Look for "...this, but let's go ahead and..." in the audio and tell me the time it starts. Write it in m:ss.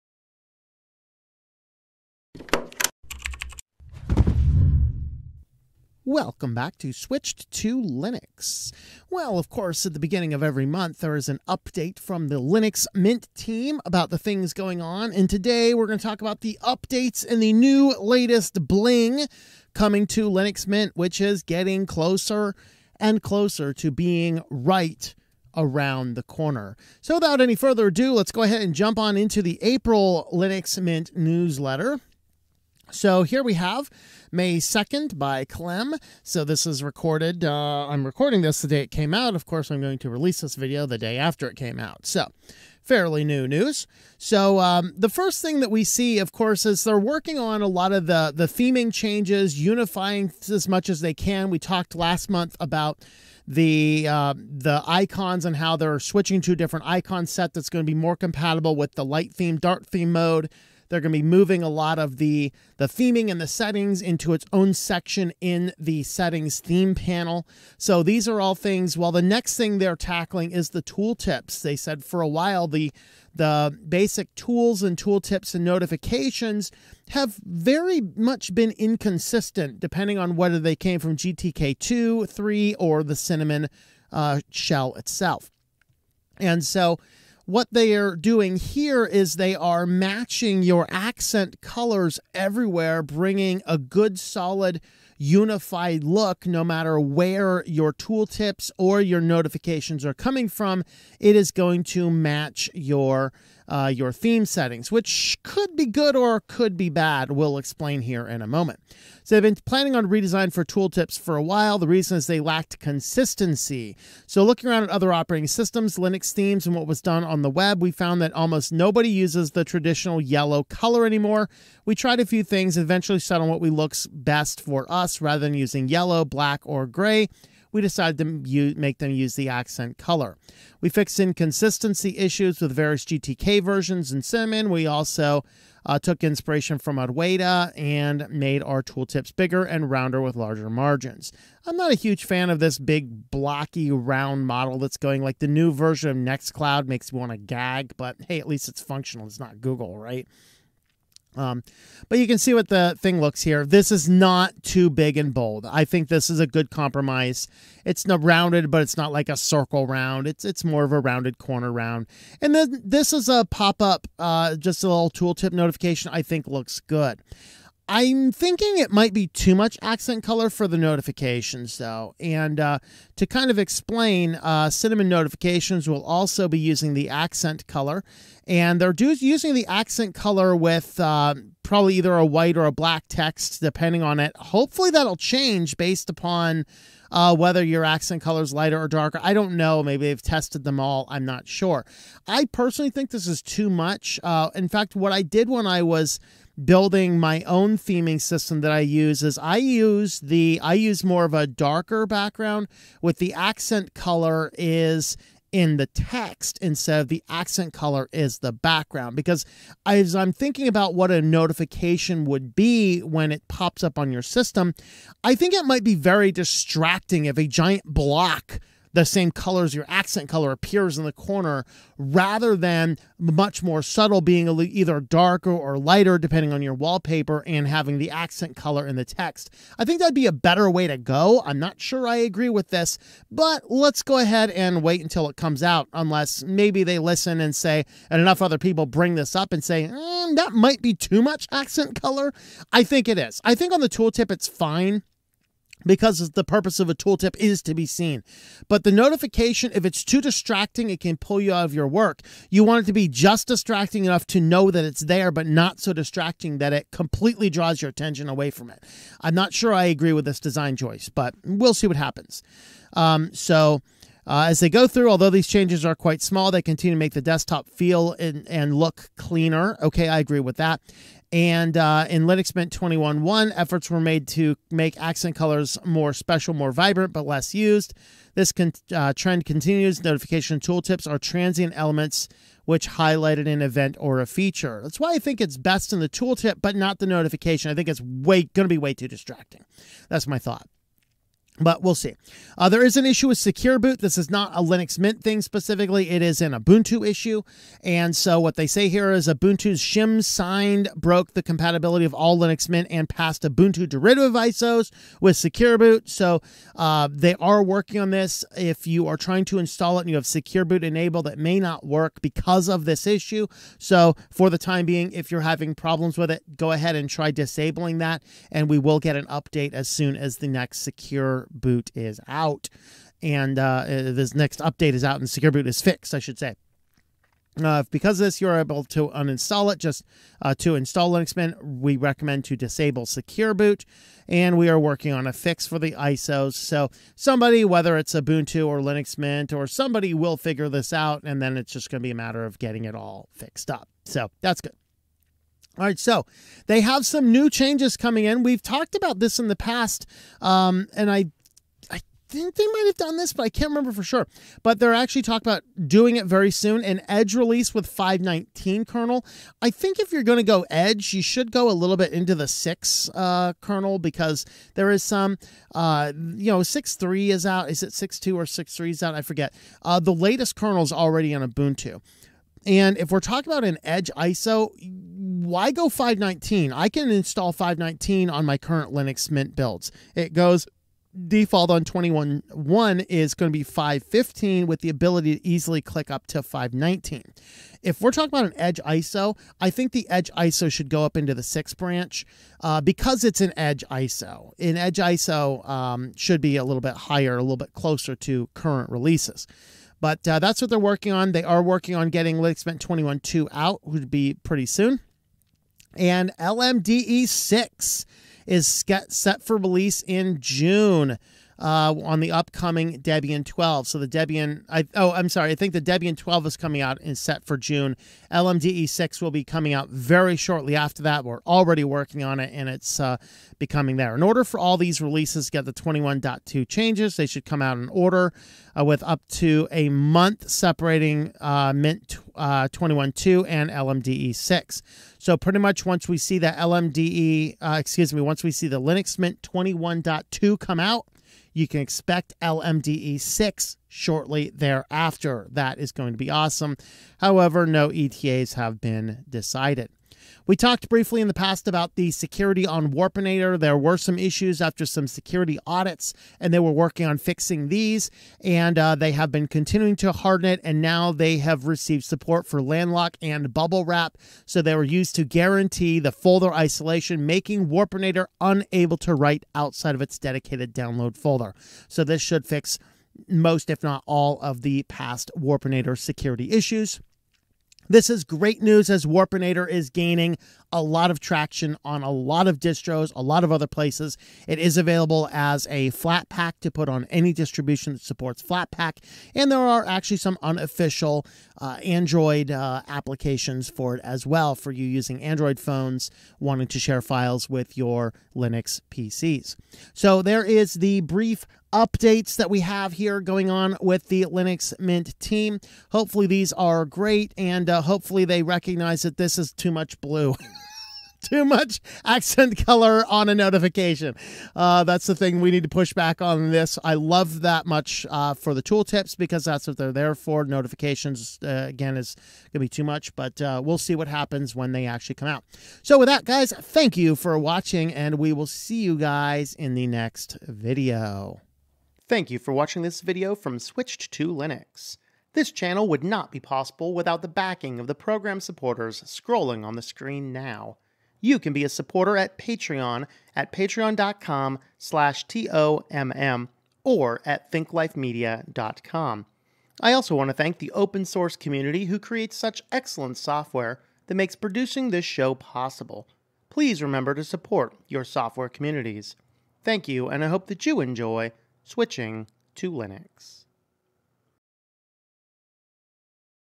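3:52.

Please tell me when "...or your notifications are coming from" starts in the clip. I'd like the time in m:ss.
1:38.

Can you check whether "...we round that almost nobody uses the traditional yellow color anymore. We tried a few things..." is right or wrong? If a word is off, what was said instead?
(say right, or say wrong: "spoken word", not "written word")
wrong: "found", not "round".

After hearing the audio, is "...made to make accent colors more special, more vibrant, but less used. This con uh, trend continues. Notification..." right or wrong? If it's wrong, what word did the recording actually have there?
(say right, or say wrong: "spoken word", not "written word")
right.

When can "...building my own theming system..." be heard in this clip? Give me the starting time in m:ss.
3:16.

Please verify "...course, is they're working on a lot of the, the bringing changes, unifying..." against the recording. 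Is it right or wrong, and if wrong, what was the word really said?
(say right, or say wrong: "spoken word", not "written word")
wrong: "theming", not "bringing".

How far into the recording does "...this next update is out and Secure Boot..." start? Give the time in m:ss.
5:23.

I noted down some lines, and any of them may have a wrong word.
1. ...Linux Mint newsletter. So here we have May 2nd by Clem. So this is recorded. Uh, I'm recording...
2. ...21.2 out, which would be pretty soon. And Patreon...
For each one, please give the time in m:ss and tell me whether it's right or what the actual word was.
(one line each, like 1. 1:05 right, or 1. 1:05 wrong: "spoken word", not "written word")
1. 0:30 right
2. 6:42 wrong: "LMDE", not "Patreon".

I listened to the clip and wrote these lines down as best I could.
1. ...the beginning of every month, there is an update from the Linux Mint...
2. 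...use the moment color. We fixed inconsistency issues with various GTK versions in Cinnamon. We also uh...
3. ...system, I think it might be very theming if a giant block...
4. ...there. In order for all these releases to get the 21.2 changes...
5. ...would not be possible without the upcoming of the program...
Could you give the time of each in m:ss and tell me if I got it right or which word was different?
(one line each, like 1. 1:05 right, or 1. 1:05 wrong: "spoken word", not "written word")
1. 0:09 right
2. 2:09 wrong: "accent", not "moment"
3. 3:34 wrong: "distracting", not "theming"
4. 7:03 right
5. 8:55 wrong: "backing", not "upcoming".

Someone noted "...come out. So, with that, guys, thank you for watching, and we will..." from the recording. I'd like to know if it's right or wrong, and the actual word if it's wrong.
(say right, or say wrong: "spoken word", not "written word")
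right.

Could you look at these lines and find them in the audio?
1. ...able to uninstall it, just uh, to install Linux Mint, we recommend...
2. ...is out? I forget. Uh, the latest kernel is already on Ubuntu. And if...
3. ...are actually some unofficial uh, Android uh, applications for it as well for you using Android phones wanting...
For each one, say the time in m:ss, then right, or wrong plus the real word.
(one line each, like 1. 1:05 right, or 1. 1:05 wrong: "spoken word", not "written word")
1. 5:28 right
2. 6:08 right
3. 8:09 right.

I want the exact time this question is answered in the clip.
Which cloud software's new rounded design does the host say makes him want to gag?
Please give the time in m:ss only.
2:26.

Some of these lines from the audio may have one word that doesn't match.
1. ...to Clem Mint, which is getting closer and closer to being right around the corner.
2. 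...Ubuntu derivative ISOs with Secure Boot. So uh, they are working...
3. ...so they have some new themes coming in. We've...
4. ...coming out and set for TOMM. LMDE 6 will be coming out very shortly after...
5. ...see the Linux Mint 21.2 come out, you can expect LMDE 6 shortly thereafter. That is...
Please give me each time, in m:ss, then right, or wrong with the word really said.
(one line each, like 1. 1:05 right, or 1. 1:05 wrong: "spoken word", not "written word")
1. 0:20 wrong: "Linux", not "Clem"
2. 5:03 right
3. 5:45 wrong: "changes", not "themes"
4. 6:56 wrong: "June", not "TOMM"
5. 7:18 right.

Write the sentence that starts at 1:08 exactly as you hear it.
Well, the next thing they're tackling is the tooltips.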